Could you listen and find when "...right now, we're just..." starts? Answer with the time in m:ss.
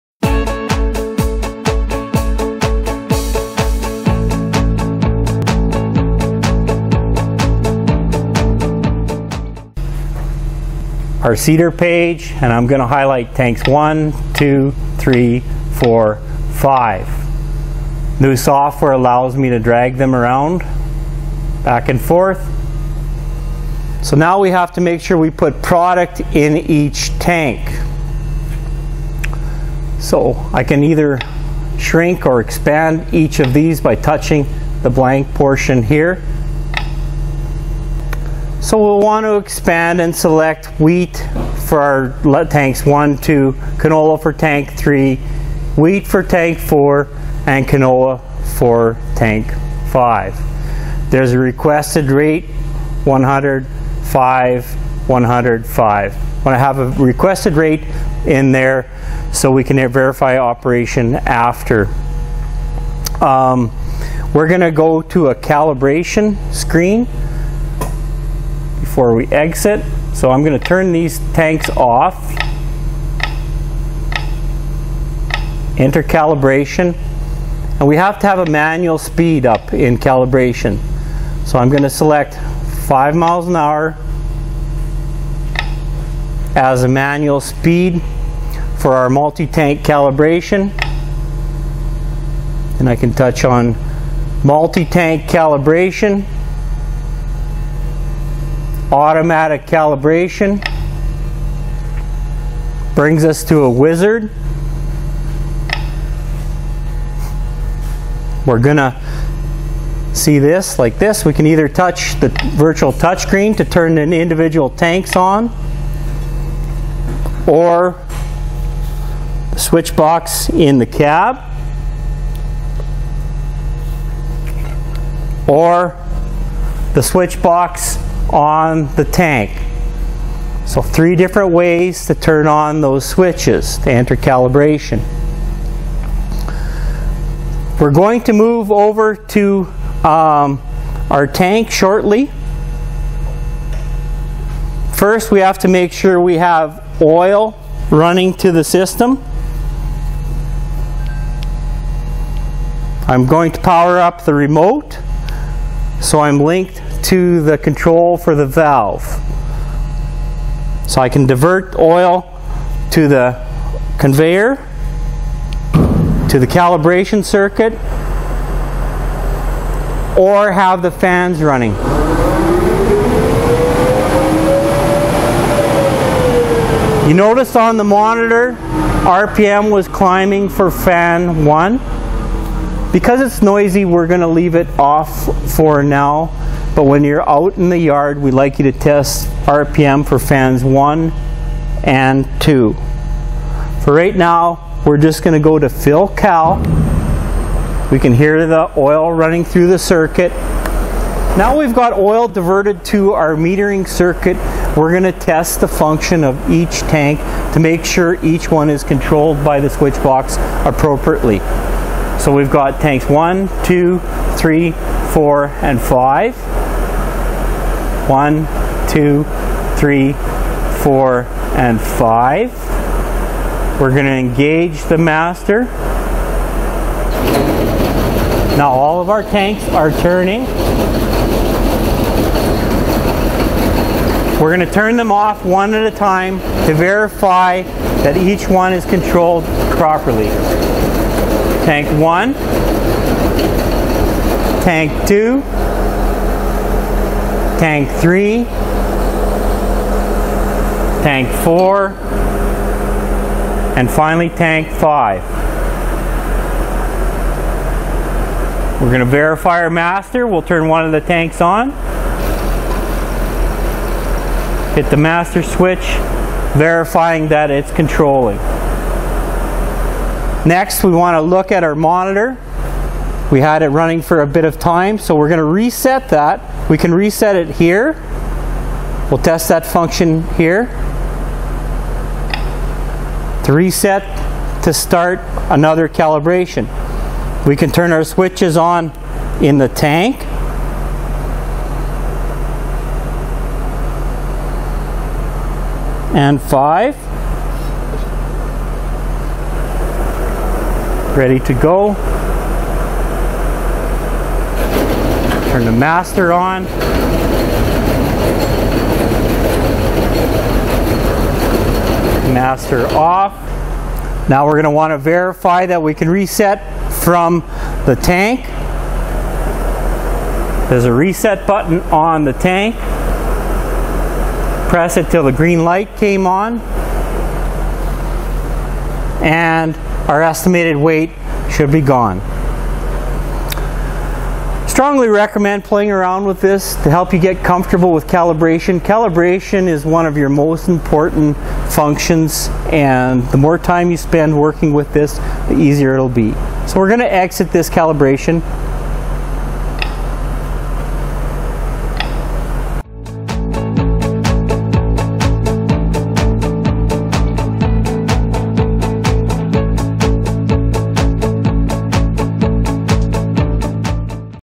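3:13.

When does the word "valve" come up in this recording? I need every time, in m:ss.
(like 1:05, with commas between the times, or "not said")
2:38.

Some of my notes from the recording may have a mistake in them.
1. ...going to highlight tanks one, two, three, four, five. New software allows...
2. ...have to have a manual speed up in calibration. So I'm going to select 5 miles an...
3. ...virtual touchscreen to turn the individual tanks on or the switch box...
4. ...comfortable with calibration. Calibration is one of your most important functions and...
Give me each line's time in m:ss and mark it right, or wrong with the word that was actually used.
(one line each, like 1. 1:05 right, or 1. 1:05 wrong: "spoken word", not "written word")
1. 0:12 right
2. 1:17 right
3. 1:52 right
4. 5:37 right.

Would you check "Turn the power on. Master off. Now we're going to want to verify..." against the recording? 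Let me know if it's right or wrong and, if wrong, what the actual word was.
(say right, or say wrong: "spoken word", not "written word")
wrong: "master", not "power".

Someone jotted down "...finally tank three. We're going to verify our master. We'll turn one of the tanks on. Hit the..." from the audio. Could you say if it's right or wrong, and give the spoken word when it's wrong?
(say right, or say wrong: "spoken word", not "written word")
wrong: "five", not "three".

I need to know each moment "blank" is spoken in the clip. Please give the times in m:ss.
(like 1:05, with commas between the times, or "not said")
0:34.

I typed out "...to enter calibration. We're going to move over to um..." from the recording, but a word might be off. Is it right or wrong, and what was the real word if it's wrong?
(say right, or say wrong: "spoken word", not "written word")
right.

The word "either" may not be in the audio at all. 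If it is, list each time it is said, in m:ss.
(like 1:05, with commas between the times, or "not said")
0:30, 1:51.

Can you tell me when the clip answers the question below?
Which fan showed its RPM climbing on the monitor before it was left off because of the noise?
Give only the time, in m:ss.
3:00.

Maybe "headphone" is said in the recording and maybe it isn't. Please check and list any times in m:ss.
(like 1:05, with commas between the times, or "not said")
not said.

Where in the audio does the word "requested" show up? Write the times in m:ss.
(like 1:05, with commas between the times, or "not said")
0:51, 0:57.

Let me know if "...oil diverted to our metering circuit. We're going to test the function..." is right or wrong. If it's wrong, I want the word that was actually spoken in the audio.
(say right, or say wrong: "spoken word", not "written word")
right.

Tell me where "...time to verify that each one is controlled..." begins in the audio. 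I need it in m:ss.
3:55.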